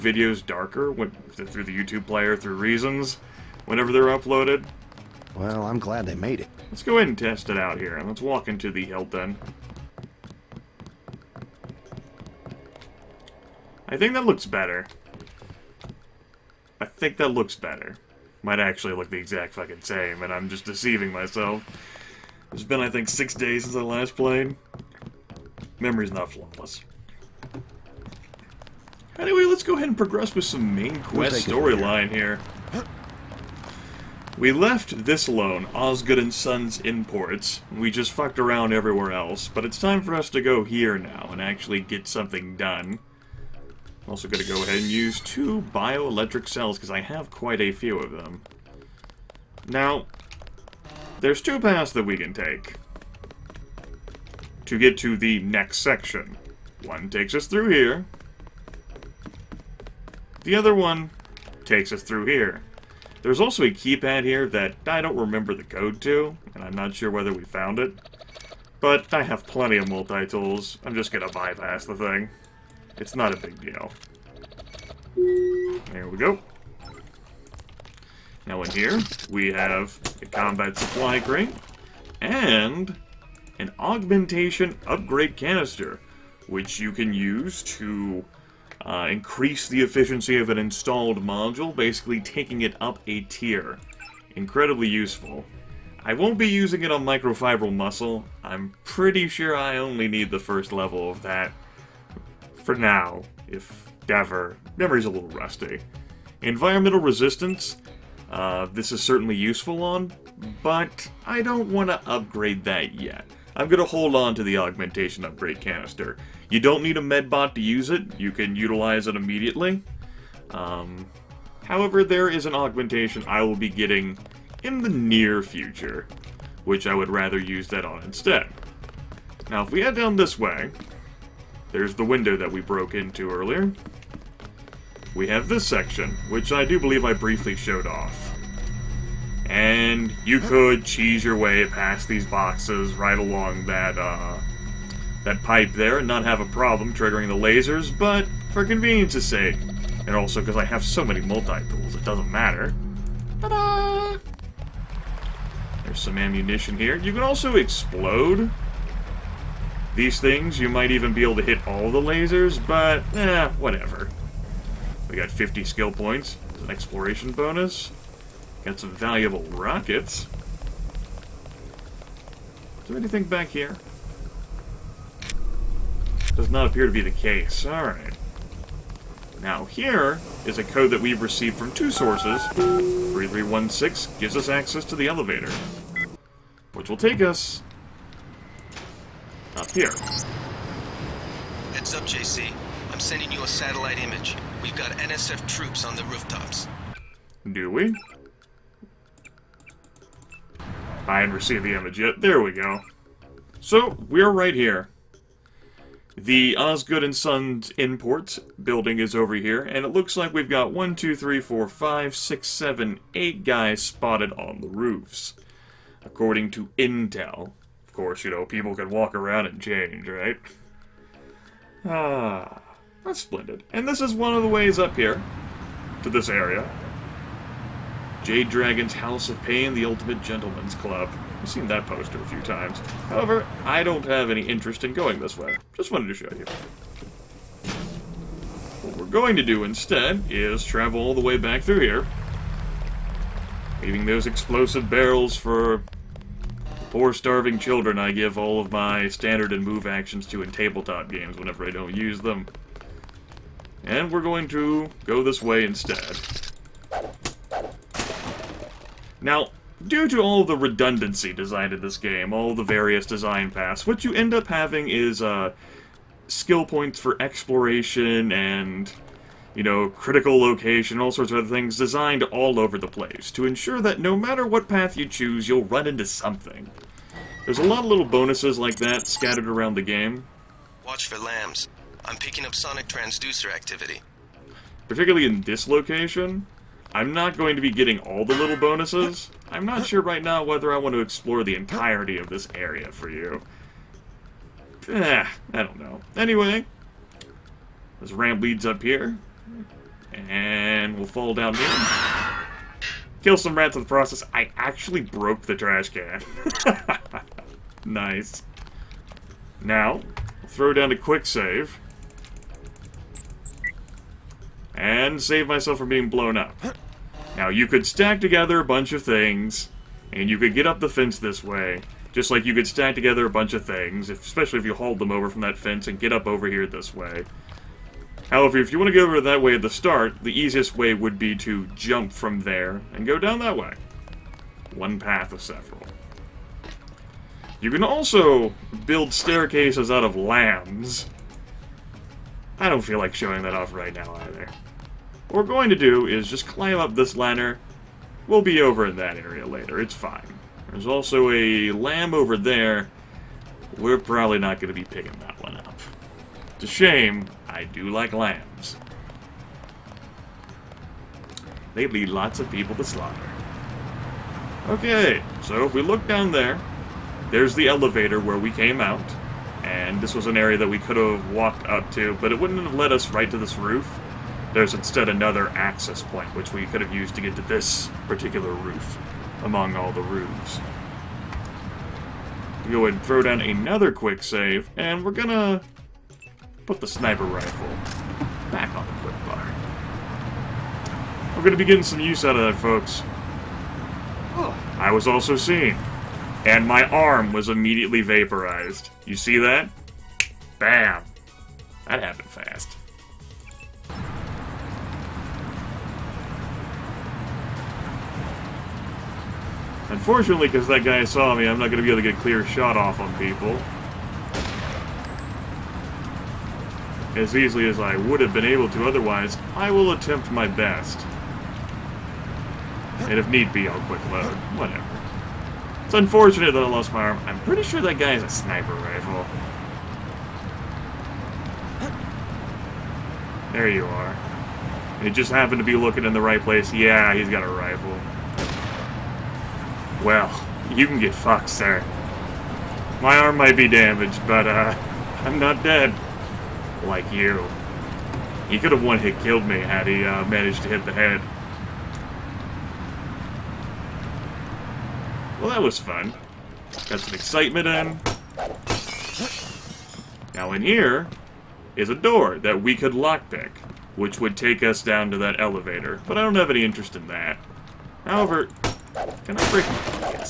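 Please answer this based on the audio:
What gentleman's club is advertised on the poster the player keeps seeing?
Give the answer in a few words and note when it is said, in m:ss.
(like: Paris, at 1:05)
Jade Dragon's House of Pain, at 3:48.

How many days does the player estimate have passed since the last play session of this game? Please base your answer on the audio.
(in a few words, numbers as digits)
6.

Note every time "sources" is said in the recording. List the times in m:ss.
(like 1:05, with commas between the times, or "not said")
3:01.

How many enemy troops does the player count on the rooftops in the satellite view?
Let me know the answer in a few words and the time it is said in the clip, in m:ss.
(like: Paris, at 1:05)
8, at 3:33.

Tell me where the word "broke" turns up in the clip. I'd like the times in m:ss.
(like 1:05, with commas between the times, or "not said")
2:12, 5:05.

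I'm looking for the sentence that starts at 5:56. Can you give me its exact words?
It's a shame, I do like LAMs.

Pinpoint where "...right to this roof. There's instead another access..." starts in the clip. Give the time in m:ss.
6:13.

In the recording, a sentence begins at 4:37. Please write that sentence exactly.
There's a lot of little bonuses like that scattered around the game.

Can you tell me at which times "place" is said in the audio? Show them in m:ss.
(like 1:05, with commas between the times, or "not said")
4:32, 7:16.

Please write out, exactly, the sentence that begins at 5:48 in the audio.
We'll be over in that area later, it's fine.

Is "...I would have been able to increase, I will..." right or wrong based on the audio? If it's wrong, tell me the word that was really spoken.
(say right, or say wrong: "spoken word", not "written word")
wrong: "otherwise", not "increase".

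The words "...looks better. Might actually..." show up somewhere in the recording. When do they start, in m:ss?
0:17.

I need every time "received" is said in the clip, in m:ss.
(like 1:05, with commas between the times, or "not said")
3:01, 3:21.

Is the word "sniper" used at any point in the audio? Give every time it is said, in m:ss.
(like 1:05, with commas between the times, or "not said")
6:26, 7:08.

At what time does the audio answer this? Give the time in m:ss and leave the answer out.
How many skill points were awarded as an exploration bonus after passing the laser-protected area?
2:45.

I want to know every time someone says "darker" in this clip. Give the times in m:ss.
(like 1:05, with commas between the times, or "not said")
0:00.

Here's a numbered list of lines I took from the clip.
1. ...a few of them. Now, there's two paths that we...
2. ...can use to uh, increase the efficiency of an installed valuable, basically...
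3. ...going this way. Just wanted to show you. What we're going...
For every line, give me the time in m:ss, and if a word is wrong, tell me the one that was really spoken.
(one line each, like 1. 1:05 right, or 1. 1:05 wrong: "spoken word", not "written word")
1. 0:47 right
2. 1:26 wrong: "module", not "valuable"
3. 3:54 right.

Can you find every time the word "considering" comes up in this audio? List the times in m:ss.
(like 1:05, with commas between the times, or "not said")
not said.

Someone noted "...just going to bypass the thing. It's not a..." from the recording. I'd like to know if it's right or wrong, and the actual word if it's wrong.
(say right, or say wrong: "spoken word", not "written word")
right.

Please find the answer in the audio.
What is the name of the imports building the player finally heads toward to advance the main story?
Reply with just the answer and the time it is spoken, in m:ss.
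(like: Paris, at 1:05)
Osgood and Sons Imports, at 0:35.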